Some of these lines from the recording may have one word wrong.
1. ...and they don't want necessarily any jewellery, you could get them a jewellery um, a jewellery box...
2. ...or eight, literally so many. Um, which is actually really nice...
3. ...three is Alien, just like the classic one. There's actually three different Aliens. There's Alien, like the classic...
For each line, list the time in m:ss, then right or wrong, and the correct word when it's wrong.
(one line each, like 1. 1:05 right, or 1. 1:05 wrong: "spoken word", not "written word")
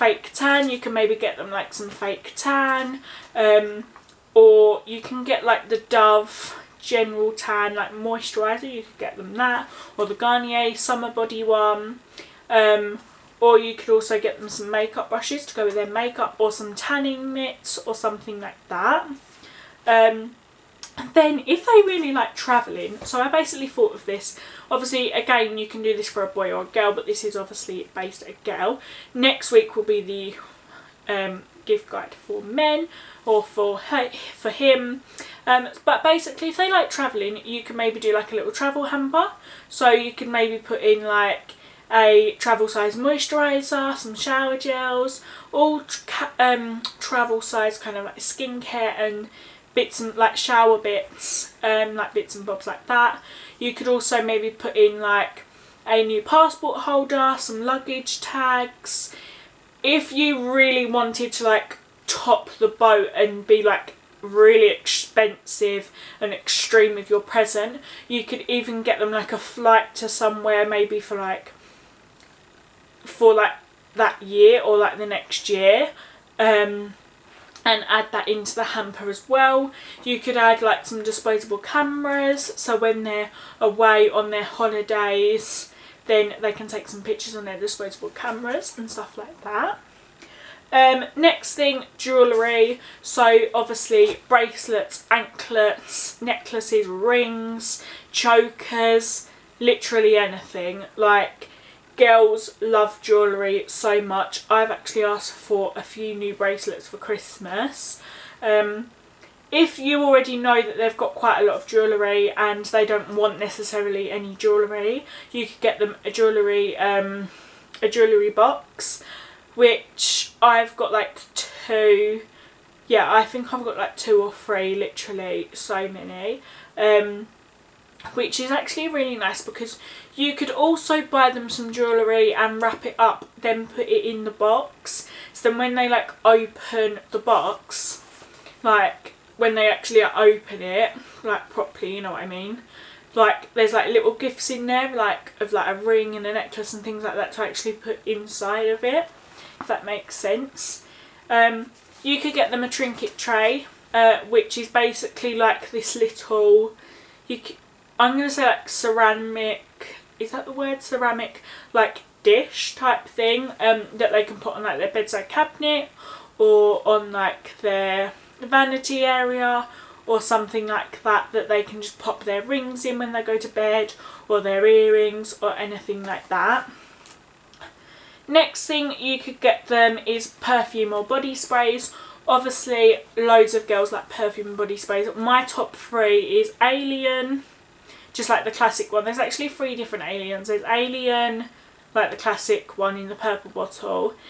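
1. 1:52 right
2. 2:04 wrong: "three", not "eight"
3. 3:05 right.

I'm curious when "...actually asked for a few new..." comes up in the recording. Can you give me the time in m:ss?
1:44.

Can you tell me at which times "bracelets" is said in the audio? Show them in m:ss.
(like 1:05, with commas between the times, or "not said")
1:34, 1:46.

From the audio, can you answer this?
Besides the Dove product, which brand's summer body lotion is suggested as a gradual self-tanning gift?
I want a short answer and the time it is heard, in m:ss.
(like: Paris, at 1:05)
Garnier, at 0:10.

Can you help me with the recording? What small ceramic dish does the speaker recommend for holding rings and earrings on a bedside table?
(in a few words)
Trinket tray.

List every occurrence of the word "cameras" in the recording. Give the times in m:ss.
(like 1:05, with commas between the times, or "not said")
1:21, 1:28.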